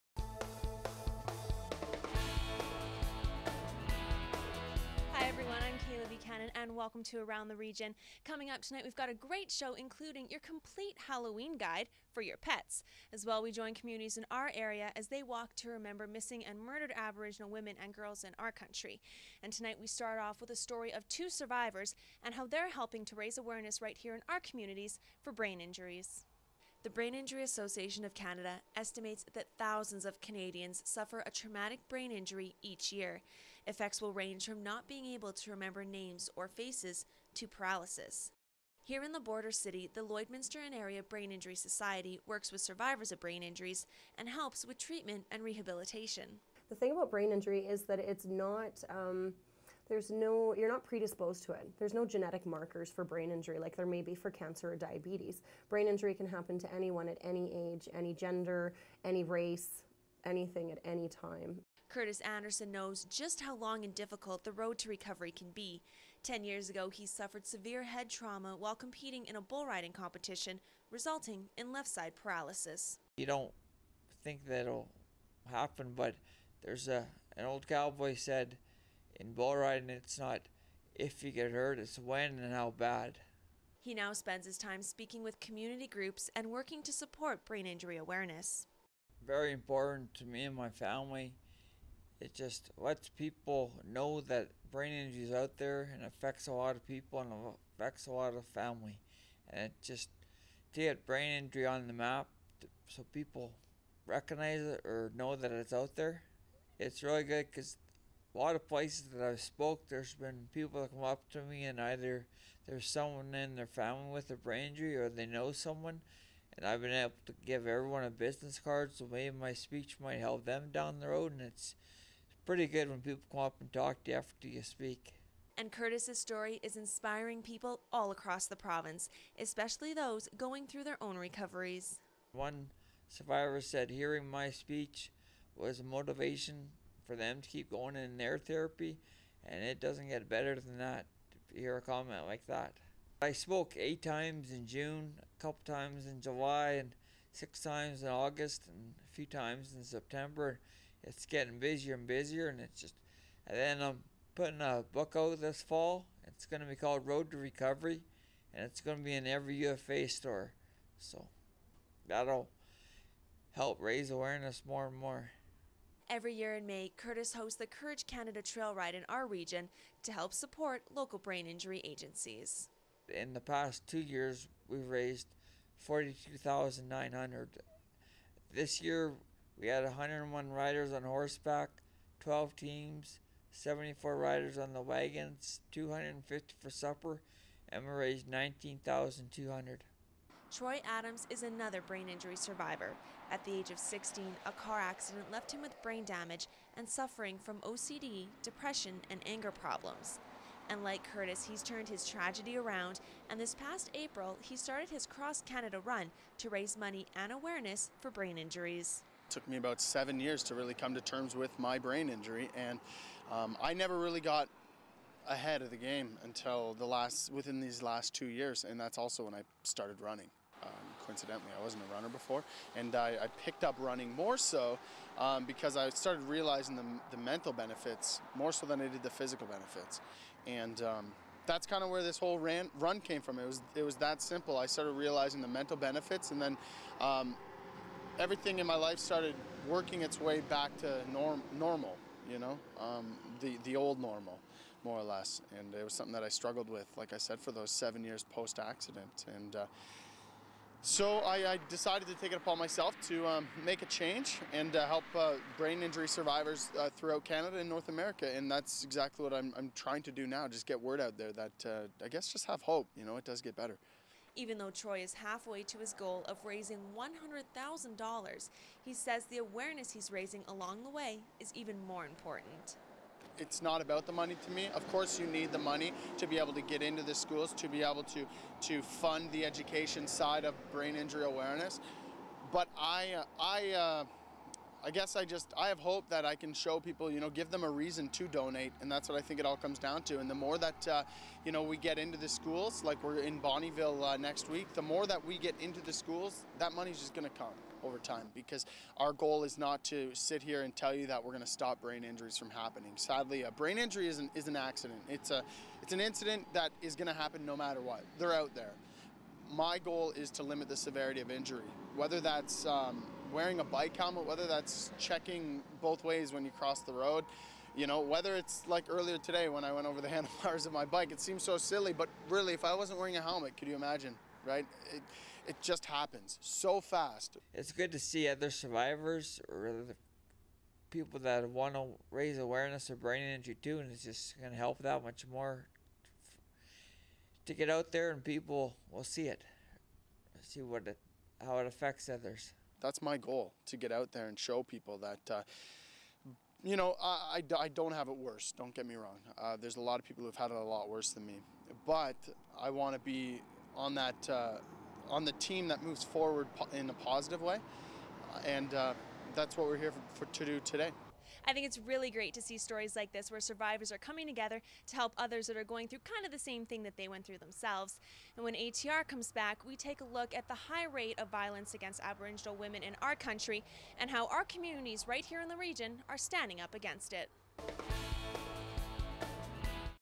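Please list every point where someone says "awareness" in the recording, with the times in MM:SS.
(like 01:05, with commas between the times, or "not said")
00:23, 01:27, 02:44, 03:27, 04:29, 04:41, 05:32.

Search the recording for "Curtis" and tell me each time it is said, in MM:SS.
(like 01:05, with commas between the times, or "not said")
01:01, 02:05, 02:46, 03:21.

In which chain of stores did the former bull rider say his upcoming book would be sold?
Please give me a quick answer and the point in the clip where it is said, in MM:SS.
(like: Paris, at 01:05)
UFA, at 02:39.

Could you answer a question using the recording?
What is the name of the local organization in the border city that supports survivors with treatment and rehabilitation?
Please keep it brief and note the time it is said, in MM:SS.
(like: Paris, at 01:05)
Lloydminster and Area Brain Injury Society, at 00:40.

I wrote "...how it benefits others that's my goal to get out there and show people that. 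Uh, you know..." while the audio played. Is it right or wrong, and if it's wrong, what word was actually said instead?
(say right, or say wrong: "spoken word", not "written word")
wrong: "affects", not "benefits".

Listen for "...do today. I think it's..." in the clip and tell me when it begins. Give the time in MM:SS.
06:00.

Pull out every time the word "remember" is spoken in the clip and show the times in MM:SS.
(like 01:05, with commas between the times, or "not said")
00:15, 00:35.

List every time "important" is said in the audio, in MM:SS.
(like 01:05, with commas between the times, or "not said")
01:29, 04:32.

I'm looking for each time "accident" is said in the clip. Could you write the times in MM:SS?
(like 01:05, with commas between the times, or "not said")
03:14, 04:08, 05:04.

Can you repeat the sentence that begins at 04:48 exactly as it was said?
And that's what I think it all comes down to.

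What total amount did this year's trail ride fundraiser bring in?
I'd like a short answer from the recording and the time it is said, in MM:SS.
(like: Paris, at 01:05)
19,200, at 03:08.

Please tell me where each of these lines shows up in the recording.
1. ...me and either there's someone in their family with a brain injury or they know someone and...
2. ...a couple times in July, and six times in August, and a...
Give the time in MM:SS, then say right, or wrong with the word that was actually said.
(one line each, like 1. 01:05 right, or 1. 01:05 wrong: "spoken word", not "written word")
1. 01:51 right
2. 02:25 right.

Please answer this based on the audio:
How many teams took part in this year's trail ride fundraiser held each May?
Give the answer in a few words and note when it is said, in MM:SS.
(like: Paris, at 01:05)
12, at 03:02.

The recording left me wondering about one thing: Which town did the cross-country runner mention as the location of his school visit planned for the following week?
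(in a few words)
Bonnyville.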